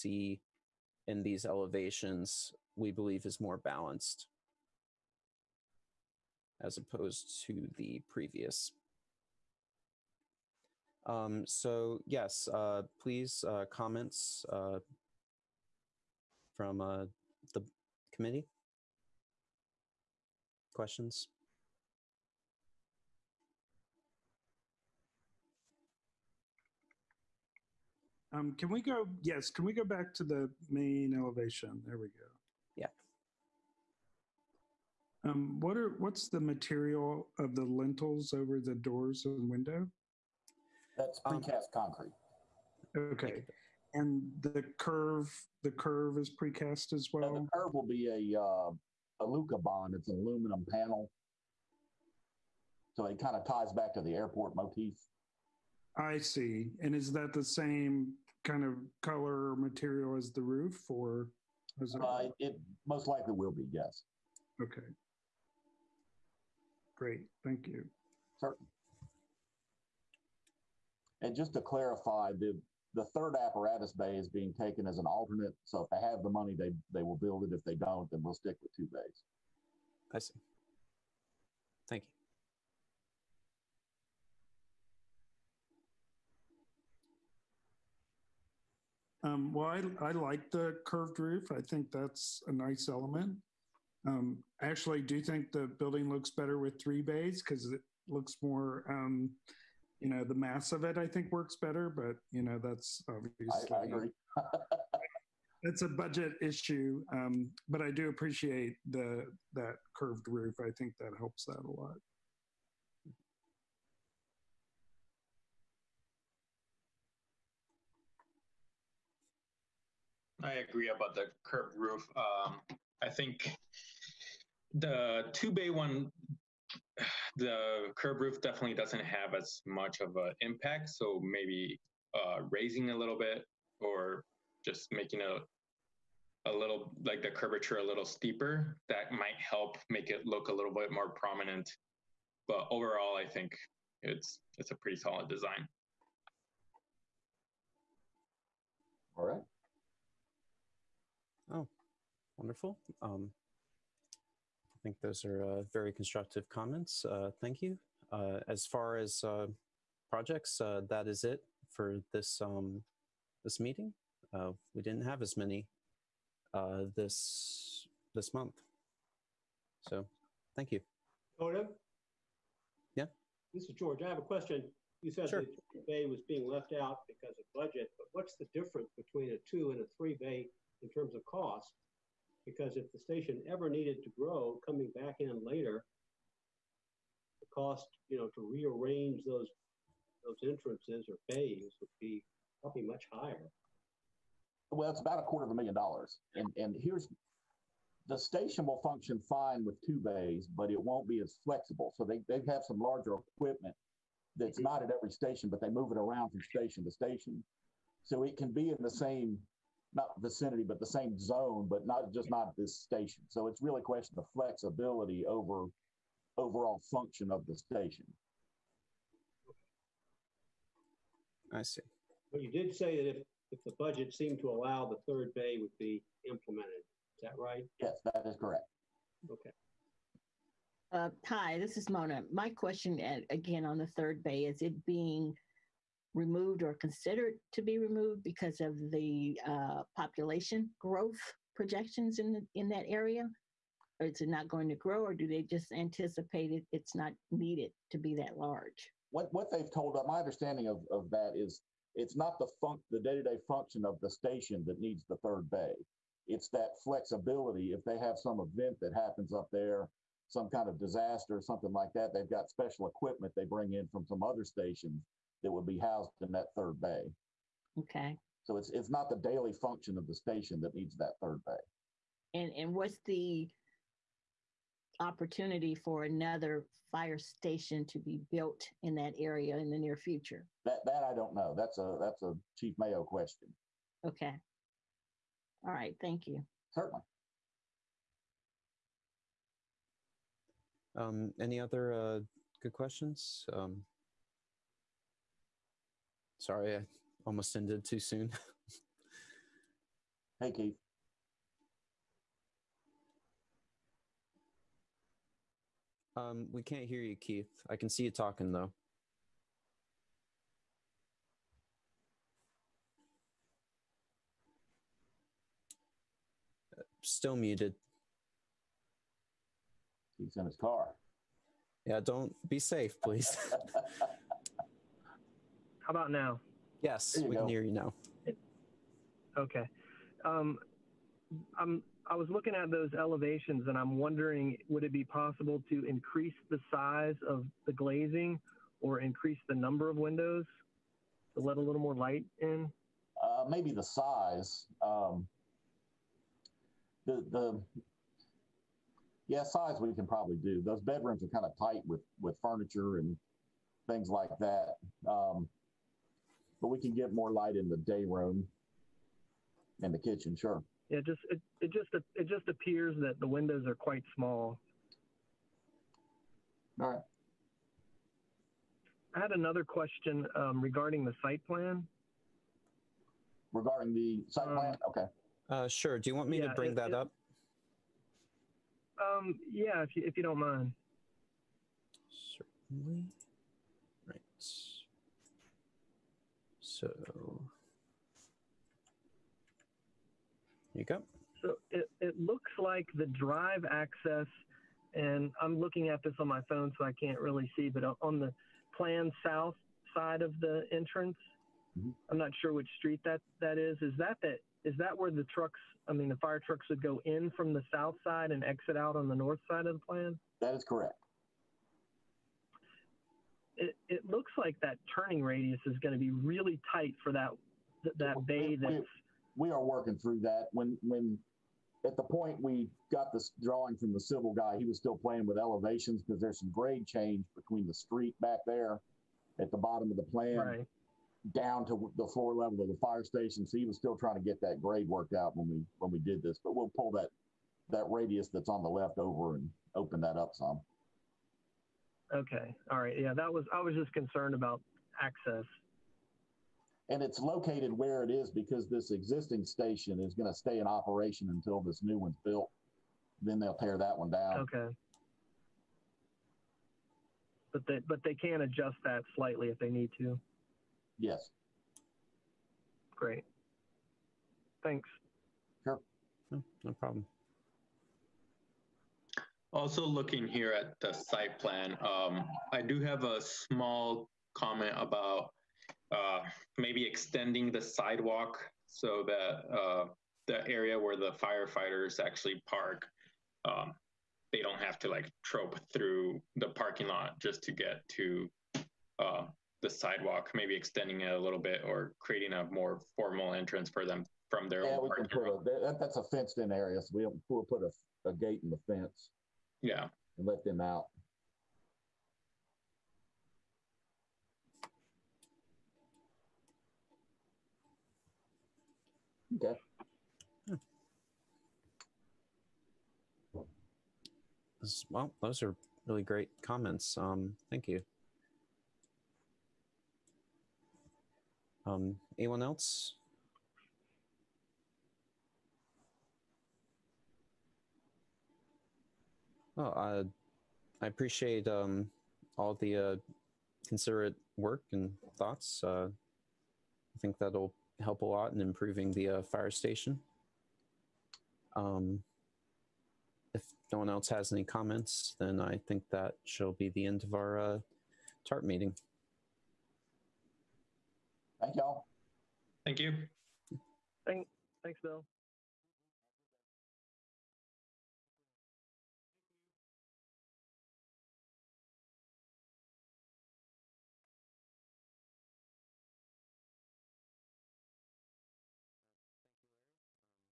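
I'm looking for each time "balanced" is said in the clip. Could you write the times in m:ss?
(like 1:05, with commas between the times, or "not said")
0:03.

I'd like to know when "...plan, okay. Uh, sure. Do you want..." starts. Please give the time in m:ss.
6:14.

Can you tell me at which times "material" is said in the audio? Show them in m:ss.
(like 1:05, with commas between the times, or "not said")
0:36, 0:59.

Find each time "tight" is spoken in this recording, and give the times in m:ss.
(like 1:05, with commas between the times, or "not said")
5:51, 6:56.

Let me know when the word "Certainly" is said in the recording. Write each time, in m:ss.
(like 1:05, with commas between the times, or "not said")
1:08, 4:46, 6:22.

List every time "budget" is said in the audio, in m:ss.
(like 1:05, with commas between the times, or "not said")
1:45, 2:57, 3:43.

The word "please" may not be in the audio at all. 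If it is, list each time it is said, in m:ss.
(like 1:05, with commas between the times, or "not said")
0:13, 5:23.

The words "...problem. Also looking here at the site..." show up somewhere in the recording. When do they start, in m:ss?
7:46.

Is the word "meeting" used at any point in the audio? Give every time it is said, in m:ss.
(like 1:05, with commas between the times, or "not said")
2:43, 9:08.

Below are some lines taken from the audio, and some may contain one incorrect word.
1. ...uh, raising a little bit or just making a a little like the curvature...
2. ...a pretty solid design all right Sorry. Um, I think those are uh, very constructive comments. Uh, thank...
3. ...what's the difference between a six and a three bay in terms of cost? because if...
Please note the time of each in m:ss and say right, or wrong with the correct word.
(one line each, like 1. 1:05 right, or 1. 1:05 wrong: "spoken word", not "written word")
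1. 2:12 right
2. 2:24 wrong: "Wonderful", not "Sorry"
3. 2:58 wrong: "two", not "six".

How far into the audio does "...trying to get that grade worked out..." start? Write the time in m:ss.
7:13.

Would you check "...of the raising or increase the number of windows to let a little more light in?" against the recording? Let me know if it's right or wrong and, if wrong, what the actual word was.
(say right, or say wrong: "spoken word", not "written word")
wrong: "glazing", not "raising".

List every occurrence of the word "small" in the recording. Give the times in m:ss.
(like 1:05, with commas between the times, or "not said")
6:04, 7:53.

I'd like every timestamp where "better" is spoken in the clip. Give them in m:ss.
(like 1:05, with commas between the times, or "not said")
1:36, 1:41.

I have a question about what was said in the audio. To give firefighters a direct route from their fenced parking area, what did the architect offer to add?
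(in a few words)
A gate.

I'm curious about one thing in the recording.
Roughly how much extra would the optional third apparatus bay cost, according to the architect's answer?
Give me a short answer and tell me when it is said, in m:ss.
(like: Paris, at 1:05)
$250,000, at 3:15.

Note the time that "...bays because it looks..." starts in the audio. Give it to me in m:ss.
1:37.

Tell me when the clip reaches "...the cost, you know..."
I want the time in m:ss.
3:07.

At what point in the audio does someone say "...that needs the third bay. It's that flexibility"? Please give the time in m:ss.
4:14.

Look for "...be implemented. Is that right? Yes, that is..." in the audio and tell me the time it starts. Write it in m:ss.
3:45.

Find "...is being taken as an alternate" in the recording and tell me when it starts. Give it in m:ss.
1:14.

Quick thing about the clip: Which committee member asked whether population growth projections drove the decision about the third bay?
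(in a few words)
Mona.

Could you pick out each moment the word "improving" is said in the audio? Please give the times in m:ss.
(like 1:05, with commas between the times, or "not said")
8:58.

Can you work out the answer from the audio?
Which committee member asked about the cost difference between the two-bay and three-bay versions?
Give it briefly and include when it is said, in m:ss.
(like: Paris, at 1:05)
George, at 2:53.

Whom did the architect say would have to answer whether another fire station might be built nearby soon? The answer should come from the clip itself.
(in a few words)
Chief Mayo.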